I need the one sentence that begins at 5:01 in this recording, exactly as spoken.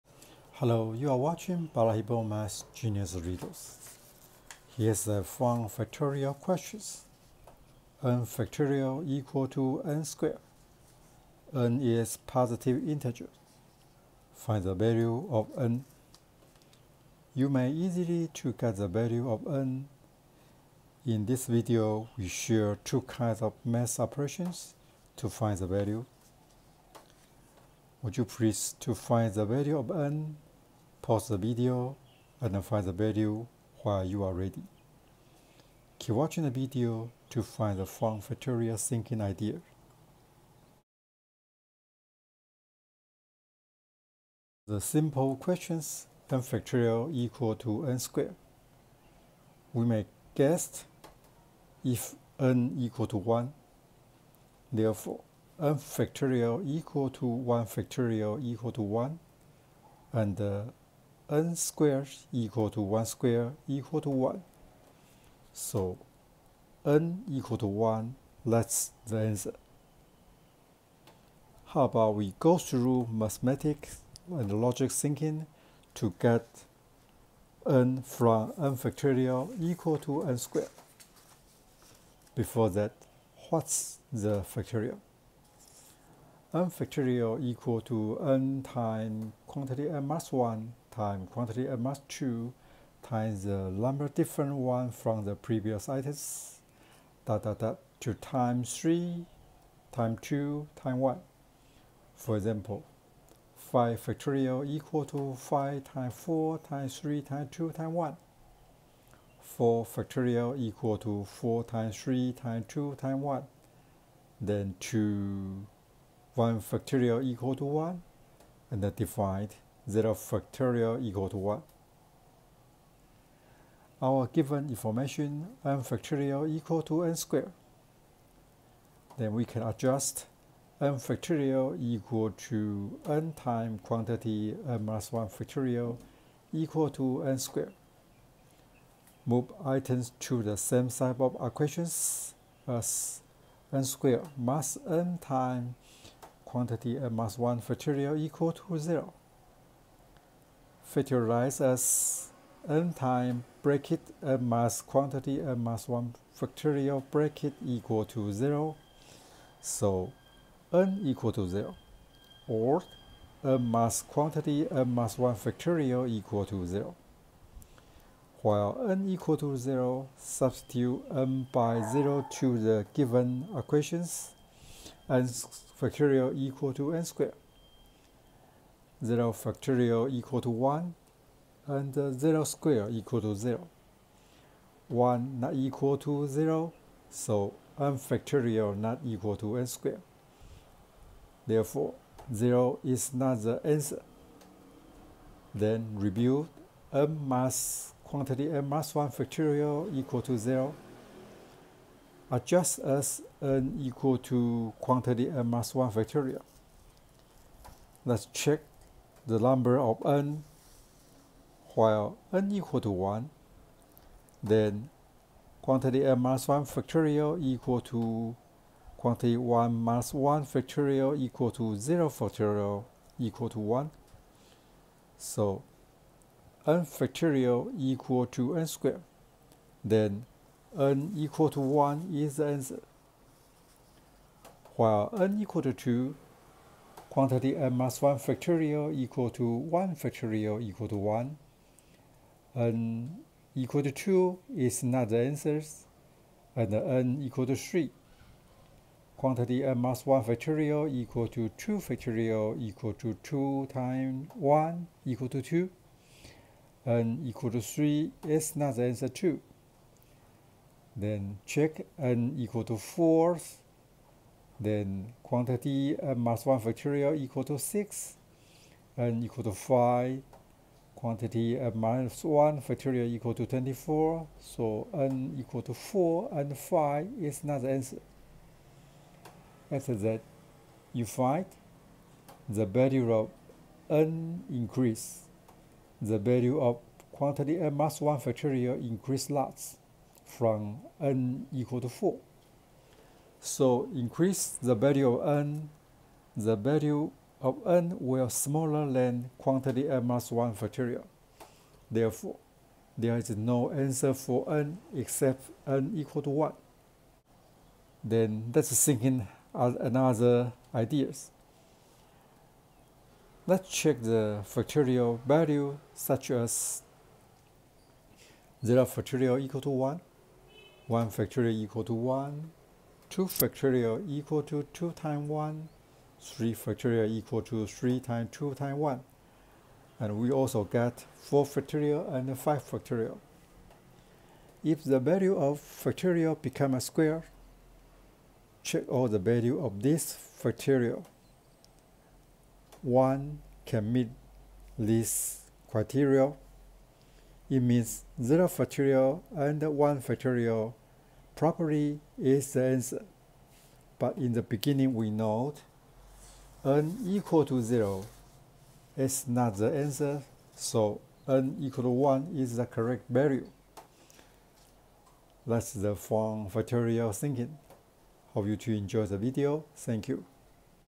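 Therefore, there is no answer for n except n equal to 1.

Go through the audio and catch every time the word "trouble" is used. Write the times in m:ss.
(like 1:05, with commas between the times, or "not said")
not said.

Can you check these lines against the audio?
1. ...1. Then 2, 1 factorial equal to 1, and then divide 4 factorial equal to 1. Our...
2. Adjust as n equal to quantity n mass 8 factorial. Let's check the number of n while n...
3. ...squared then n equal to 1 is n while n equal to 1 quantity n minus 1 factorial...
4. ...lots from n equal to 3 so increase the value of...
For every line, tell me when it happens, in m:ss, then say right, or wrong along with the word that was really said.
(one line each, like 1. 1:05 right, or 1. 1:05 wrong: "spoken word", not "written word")
1. 1:53 wrong: "0", not "4"
2. 3:22 wrong: "1", not "8"
3. 3:48 wrong: "2", not "1"
4. 4:49 wrong: "4", not "3".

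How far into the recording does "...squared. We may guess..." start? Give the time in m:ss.
0:47.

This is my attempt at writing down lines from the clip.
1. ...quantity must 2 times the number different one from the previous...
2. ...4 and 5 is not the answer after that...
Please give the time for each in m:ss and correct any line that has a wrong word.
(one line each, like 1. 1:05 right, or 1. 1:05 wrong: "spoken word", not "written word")
1. 1:31 right
2. 4:35 right.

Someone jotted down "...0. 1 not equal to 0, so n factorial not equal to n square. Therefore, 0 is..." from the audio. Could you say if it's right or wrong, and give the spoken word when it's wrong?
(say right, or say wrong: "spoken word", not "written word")
right.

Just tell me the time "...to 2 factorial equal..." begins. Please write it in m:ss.
4:11.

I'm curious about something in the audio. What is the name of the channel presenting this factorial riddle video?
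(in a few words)
Balahippo Math Genius Riddles.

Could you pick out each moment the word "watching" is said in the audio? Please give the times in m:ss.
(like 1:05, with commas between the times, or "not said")
0:01, 0:36.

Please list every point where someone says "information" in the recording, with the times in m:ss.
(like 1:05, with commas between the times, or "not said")
2:04.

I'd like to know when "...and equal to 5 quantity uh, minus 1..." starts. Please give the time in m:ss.
4:28.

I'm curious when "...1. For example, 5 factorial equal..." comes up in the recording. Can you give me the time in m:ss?
1:40.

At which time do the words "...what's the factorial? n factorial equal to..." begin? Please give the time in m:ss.
1:23.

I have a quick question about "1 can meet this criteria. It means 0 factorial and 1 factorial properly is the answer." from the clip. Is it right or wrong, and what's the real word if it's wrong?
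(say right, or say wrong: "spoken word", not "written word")
right.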